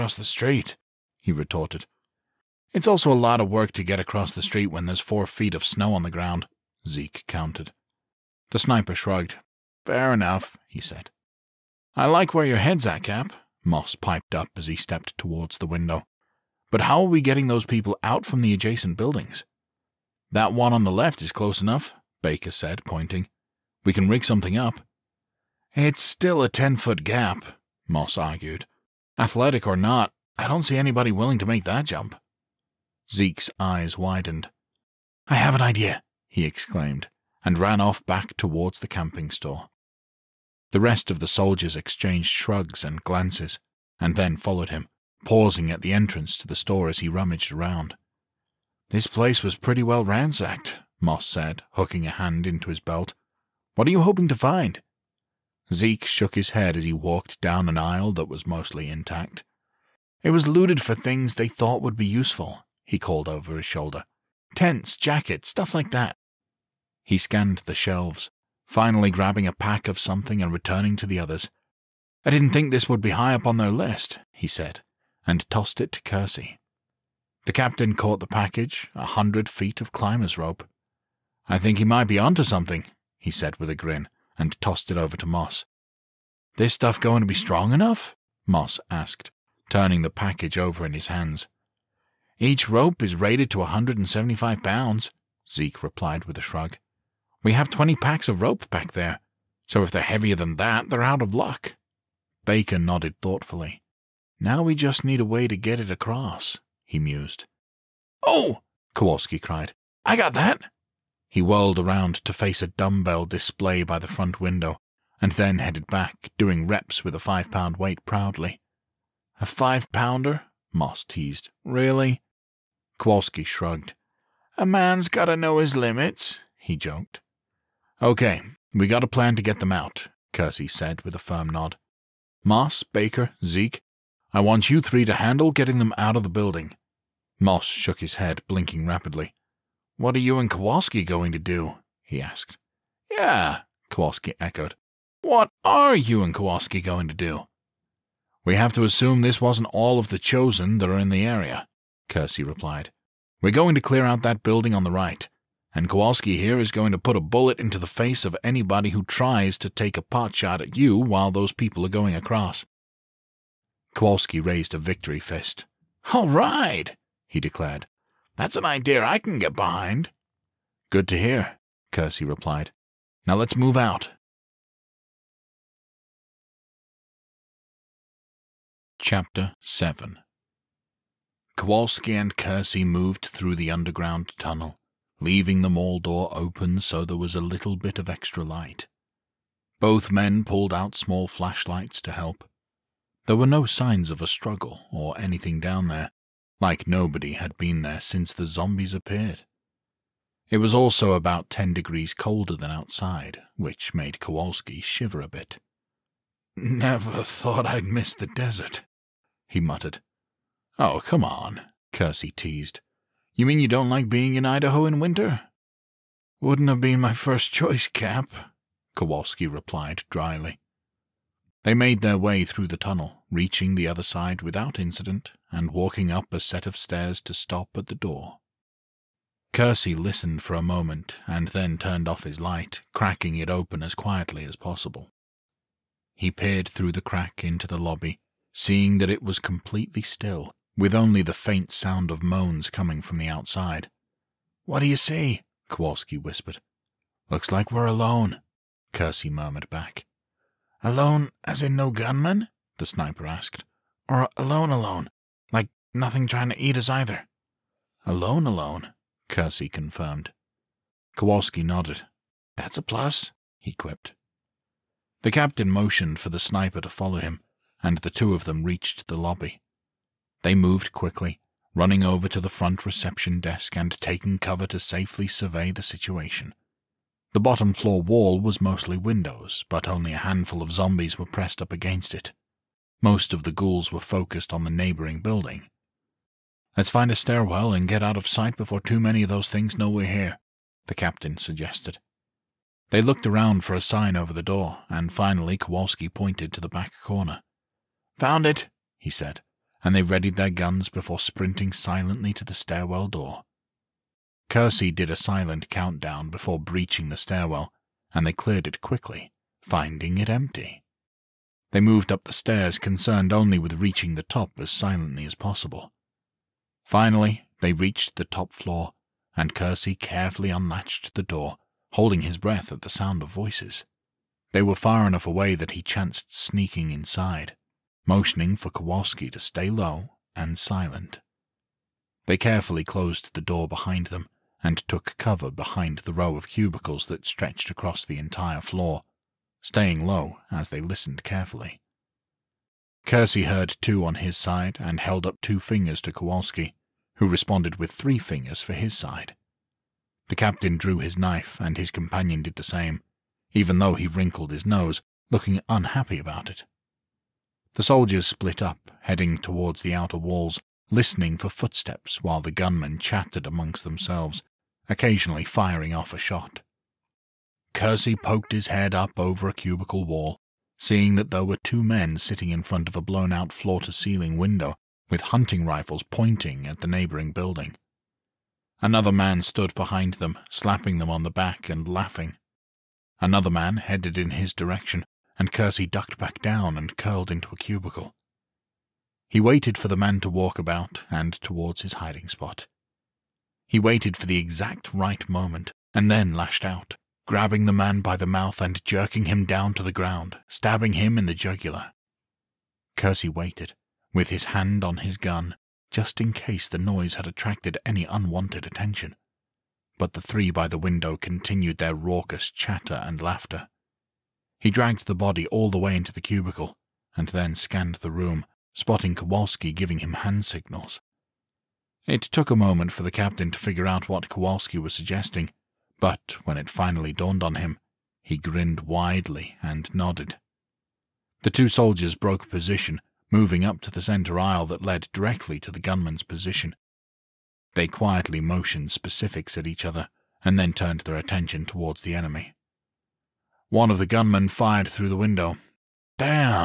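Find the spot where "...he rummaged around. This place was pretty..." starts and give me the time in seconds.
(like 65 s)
46 s.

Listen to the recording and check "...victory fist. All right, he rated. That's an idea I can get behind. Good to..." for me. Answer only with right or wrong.
wrong.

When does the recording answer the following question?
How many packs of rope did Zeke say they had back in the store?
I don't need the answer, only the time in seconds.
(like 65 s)
97 s.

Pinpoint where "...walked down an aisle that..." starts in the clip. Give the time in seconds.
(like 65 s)
56 s.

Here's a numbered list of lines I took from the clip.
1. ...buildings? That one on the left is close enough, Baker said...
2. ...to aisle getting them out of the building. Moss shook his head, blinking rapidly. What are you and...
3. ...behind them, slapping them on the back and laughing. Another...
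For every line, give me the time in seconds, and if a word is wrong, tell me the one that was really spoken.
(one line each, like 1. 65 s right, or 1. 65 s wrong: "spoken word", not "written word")
1. 18 s right
2. 135 s wrong: "handle", not "aisle"
3. 379 s right.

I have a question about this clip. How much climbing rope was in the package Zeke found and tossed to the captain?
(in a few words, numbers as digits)
100 feet.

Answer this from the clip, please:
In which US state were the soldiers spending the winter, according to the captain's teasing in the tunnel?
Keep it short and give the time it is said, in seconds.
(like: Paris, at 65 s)
Idaho, at 214 s.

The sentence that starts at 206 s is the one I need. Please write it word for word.
Never thought I'd miss the desert, he muttered.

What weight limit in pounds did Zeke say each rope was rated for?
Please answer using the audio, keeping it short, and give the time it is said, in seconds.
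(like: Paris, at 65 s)
175 pounds, at 93 s.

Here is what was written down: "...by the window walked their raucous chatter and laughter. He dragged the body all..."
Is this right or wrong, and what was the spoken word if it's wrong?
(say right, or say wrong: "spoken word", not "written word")
wrong: "continued", not "walked".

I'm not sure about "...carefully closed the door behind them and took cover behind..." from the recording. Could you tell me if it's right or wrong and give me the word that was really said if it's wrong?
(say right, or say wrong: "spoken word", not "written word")
right.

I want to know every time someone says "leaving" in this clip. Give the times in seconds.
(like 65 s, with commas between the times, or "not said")
185 s.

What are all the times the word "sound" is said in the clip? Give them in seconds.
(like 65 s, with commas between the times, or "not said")
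241 s, 322 s.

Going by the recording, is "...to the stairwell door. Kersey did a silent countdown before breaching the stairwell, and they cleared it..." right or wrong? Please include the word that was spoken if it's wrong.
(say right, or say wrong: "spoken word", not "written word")
right.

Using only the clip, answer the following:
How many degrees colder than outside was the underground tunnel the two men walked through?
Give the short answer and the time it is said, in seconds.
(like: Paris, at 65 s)
10 degrees, at 201 s.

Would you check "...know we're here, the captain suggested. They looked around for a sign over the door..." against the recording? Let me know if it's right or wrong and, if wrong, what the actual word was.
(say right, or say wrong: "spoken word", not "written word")
right.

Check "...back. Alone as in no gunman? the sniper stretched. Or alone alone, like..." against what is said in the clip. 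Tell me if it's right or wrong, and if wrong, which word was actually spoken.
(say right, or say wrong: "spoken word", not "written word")
wrong: "asked", not "stretched".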